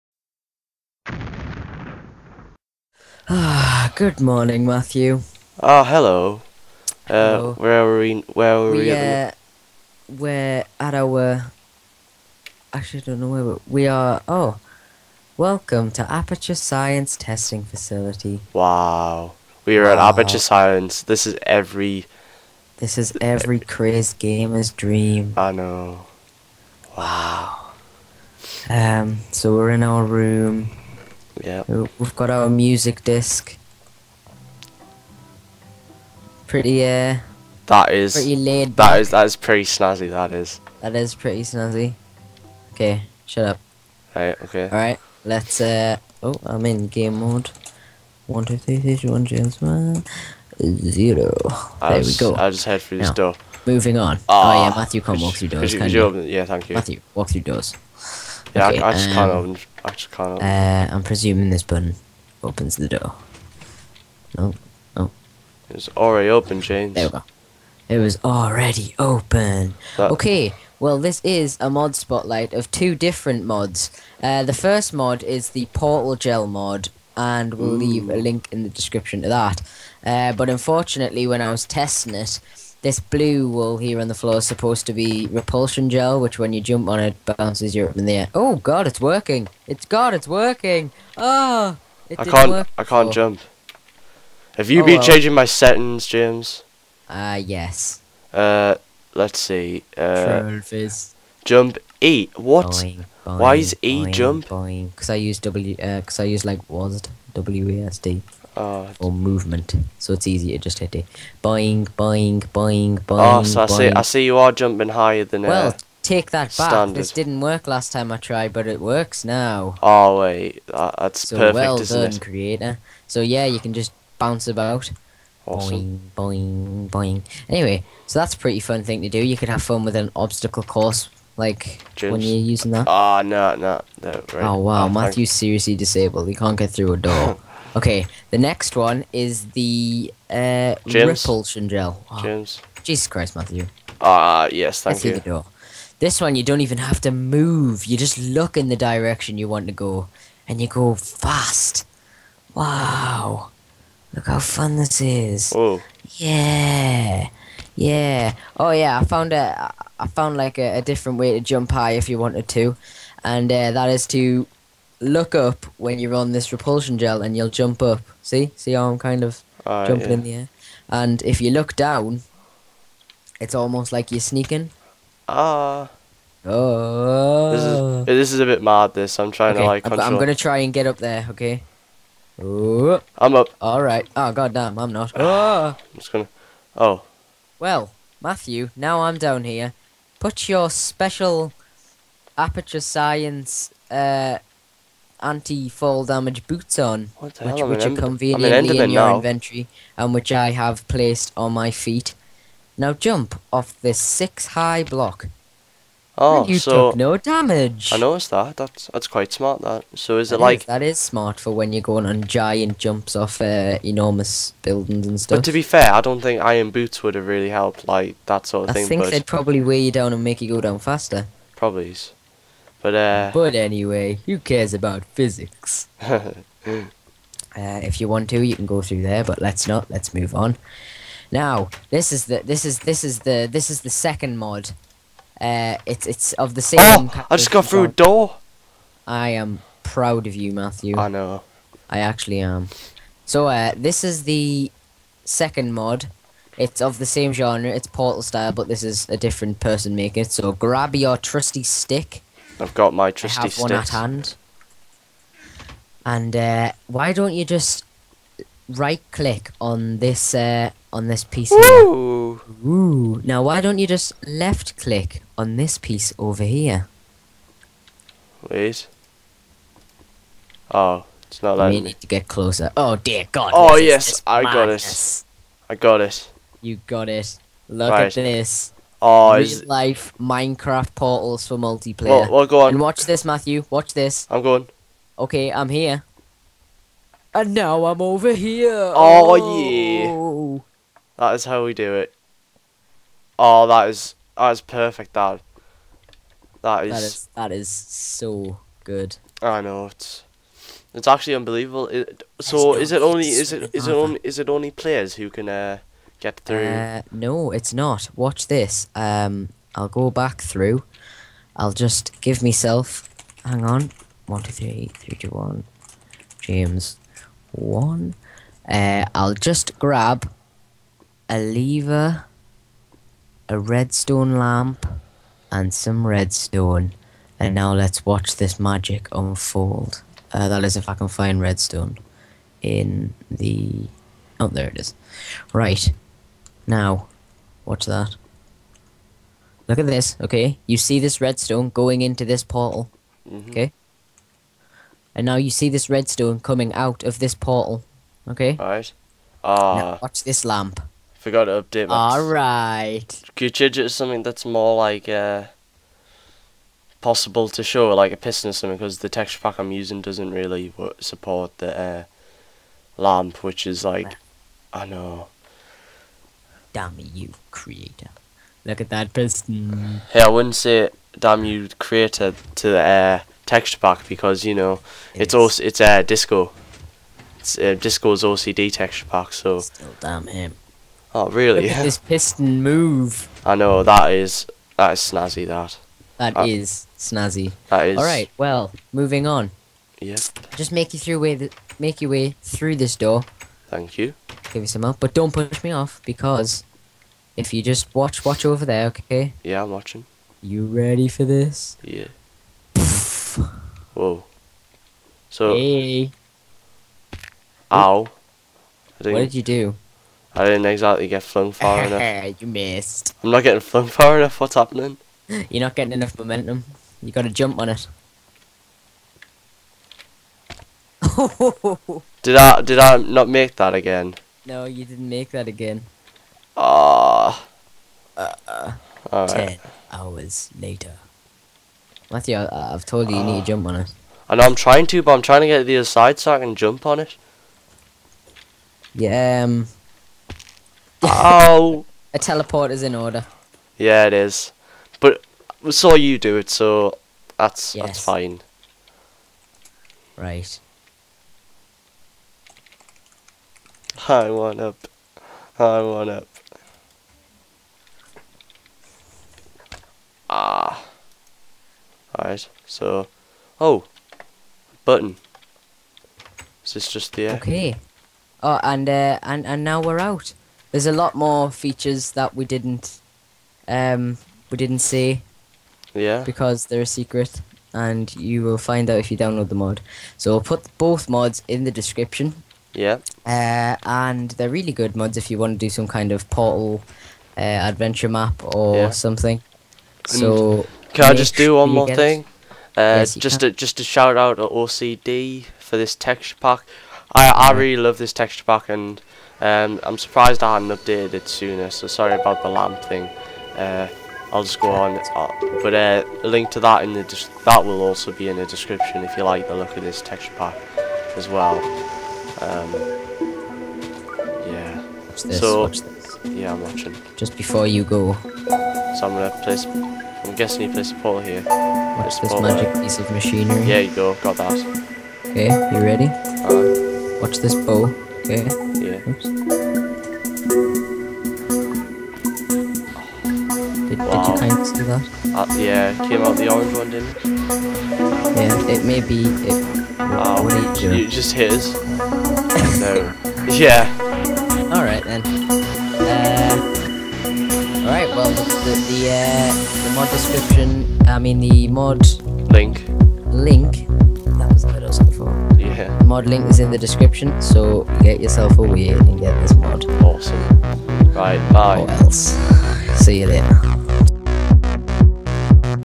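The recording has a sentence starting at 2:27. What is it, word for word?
You just look in the direction you want to go, and you go fast.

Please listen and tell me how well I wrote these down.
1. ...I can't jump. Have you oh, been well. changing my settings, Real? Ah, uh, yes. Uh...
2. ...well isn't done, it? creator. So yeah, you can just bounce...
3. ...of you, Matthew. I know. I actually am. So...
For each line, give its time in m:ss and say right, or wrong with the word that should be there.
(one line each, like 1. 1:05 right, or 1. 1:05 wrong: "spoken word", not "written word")
1. 1:32 wrong: "James", not "Real"
2. 2:01 right
3. 4:00 right.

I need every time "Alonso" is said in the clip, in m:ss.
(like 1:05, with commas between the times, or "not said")
not said.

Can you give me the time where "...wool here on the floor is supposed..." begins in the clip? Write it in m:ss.
1:23.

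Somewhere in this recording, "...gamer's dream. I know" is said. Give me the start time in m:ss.
0:24.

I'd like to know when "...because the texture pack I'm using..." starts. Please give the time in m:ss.
5:58.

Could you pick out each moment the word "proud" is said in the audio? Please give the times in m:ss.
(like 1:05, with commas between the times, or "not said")
3:59.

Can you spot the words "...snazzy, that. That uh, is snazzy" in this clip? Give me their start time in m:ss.
6:24.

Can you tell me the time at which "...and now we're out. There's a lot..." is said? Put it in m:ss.
7:49.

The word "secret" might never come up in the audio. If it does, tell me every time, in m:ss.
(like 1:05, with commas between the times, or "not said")
7:56.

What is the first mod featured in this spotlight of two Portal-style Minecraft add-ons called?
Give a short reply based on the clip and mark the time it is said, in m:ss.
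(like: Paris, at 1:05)
Portal Gel mod, at 1:15.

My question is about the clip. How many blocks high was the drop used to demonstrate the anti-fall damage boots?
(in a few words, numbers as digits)
6.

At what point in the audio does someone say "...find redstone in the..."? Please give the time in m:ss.
5:31.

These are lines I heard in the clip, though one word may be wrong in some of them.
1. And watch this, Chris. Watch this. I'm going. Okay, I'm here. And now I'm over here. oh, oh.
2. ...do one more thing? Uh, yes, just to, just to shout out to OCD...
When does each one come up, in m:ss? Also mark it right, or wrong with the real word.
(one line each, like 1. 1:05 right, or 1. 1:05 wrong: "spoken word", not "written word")
1. 4:42 wrong: "Matthew", not "Chris"
2. 8:11 right.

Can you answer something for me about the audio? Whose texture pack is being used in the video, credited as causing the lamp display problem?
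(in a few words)
Disco's OCD texture pack.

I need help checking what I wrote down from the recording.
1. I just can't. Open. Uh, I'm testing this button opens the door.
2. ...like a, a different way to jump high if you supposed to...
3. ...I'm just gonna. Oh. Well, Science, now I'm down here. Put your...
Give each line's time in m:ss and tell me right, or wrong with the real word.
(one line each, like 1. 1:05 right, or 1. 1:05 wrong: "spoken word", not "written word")
1. 0:59 wrong: "presuming", not "testing"
2. 2:40 wrong: "wanted", not "supposed"
3. 3:05 wrong: "Matthew", not "Science".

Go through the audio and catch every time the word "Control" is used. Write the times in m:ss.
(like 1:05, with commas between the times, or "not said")
2:59.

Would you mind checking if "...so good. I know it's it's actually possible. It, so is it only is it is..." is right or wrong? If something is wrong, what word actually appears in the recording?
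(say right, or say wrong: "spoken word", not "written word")
wrong: "unbelievable", not "possible".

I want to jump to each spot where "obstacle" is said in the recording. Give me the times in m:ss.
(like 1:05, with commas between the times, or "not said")
2:10.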